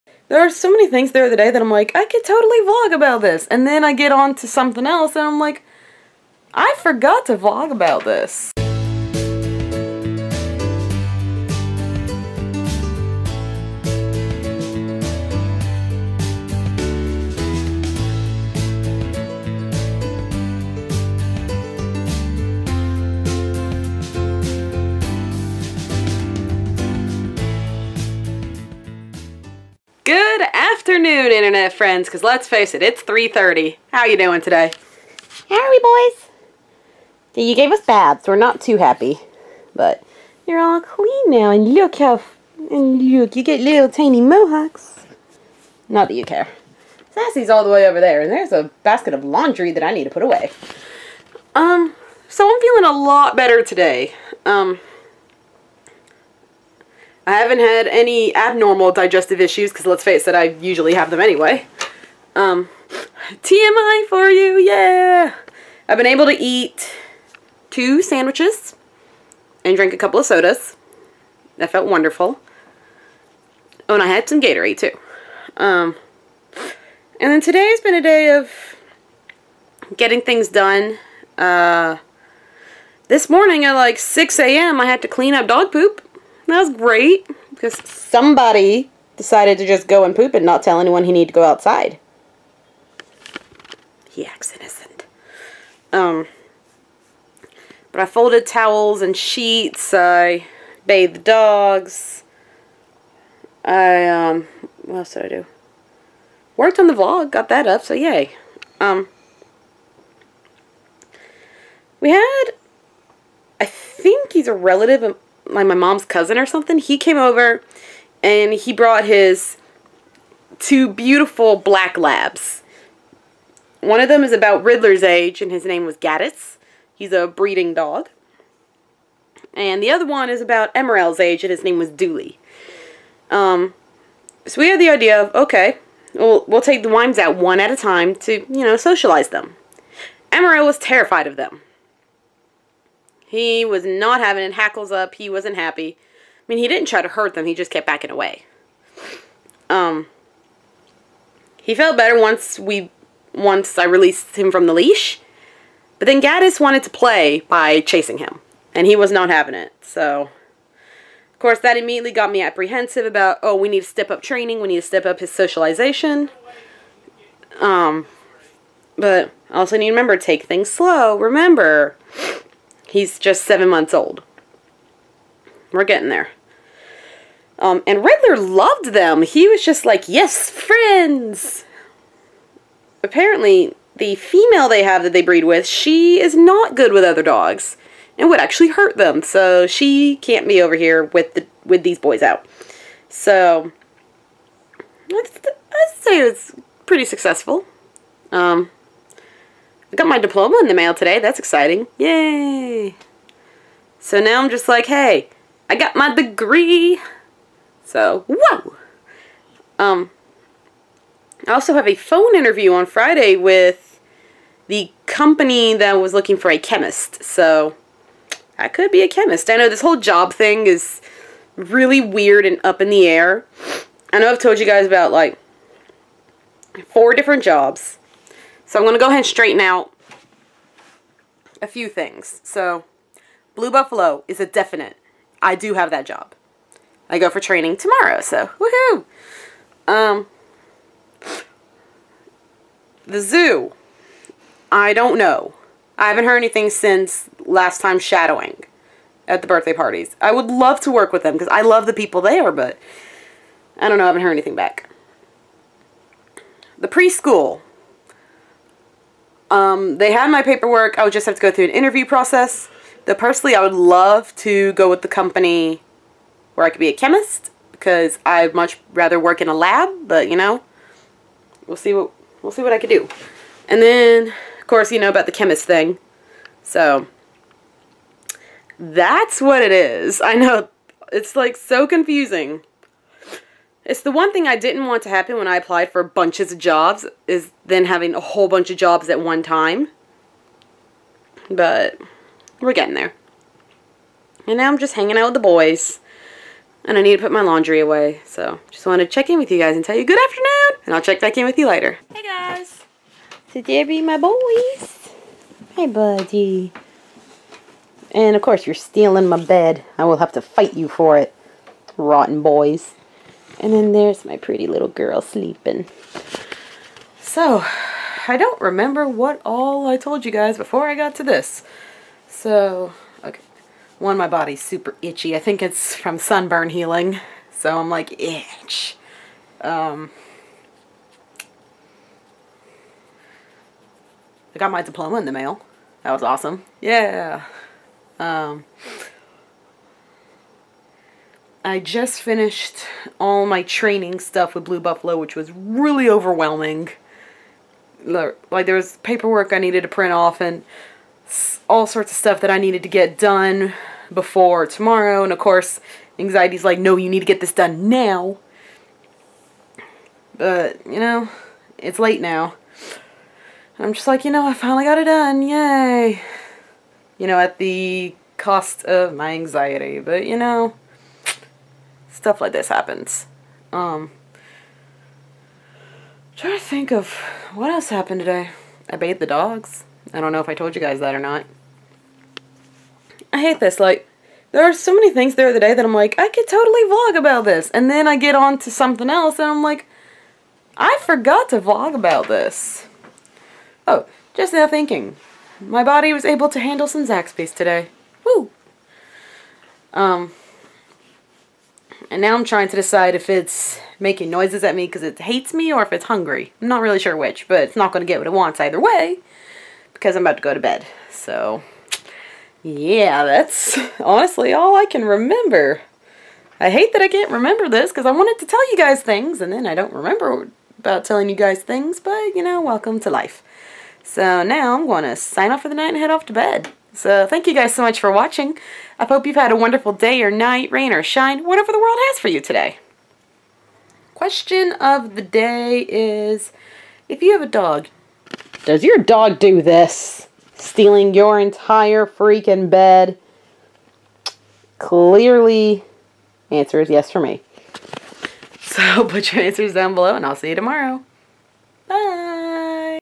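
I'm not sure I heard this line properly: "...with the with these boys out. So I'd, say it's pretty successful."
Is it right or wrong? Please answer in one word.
right.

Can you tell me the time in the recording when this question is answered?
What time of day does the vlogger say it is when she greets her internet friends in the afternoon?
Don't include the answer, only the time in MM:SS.
00:33.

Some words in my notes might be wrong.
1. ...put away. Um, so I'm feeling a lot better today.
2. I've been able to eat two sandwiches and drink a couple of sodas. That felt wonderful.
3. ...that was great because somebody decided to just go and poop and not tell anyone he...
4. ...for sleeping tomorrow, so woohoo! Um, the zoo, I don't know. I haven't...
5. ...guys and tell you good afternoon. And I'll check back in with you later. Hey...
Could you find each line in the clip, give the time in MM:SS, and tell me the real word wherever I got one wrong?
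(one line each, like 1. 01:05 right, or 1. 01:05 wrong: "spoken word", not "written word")
1. 00:50 right
2. 01:05 right
3. 01:26 right
4. 03:57 wrong: "training", not "sleeping"
5. 04:59 right.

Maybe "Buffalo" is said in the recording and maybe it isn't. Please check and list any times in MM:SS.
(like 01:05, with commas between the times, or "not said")
03:53, 05:44.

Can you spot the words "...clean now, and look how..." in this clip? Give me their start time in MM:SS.
00:40.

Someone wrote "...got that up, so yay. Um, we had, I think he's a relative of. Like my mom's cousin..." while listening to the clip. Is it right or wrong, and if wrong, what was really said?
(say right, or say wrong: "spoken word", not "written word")
right.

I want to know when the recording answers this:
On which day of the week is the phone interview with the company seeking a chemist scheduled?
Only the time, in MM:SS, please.
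03:32.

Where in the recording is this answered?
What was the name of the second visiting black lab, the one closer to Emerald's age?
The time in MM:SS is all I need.
02:11.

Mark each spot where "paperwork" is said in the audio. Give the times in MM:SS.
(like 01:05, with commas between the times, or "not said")
04:20, 05:49.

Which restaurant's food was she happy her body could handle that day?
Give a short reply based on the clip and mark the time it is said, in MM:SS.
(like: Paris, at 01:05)
Zaxby's, at 06:37.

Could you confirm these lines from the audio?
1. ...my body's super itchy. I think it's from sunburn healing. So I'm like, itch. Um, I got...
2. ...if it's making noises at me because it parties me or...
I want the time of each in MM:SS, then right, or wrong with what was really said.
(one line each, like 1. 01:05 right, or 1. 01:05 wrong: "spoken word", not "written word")
1. 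05:24 right
2. 06:43 wrong: "hates", not "parties".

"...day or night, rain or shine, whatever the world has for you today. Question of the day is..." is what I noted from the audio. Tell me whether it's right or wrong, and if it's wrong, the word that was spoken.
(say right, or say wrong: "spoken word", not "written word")
right.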